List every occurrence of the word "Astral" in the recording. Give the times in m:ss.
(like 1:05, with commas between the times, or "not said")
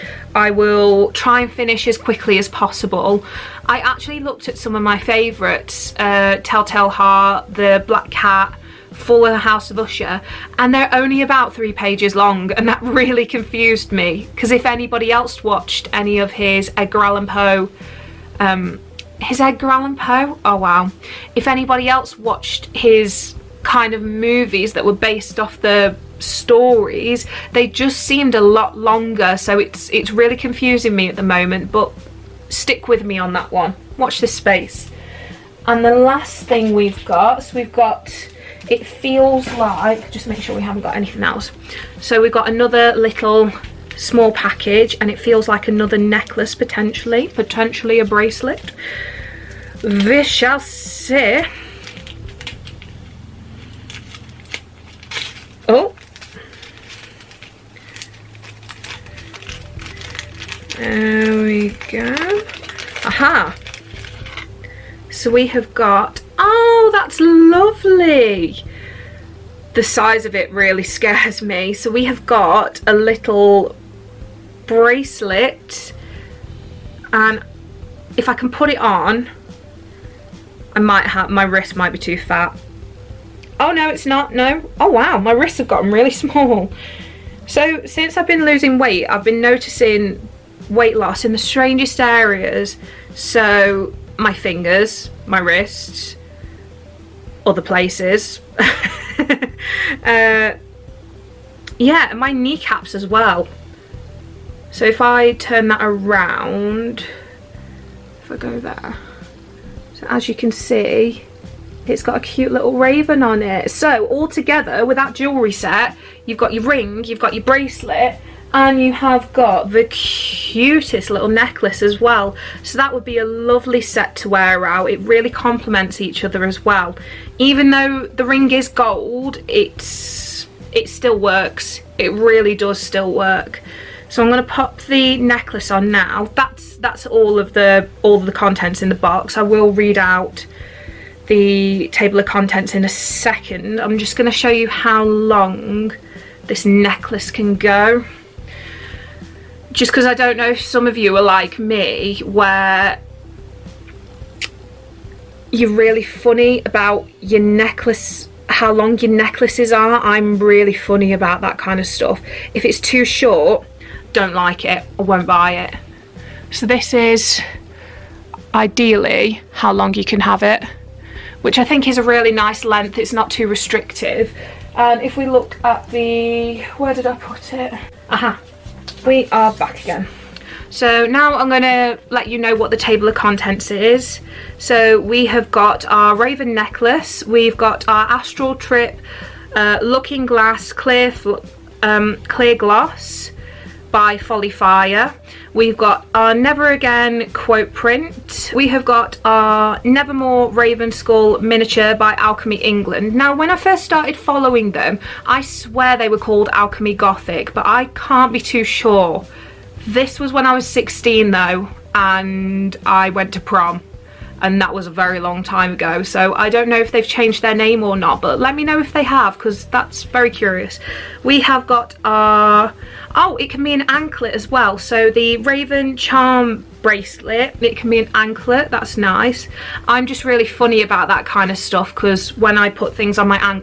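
3:08.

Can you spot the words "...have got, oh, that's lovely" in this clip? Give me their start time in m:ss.
1:05.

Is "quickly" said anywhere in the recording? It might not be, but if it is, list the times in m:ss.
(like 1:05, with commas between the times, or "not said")
0:01.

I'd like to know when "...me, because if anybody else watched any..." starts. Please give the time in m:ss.
0:13.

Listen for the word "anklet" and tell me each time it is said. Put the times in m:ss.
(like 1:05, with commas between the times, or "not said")
3:43, 3:48.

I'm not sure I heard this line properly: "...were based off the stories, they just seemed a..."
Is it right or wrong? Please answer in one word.
right.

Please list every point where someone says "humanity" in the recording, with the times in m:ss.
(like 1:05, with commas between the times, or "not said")
not said.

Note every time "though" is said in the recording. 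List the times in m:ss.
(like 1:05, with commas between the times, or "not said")
2:07, 3:31.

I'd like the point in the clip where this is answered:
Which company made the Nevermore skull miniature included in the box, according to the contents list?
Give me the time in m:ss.
3:22.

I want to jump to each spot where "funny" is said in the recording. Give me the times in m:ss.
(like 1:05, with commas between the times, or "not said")
2:36, 2:40, 3:50.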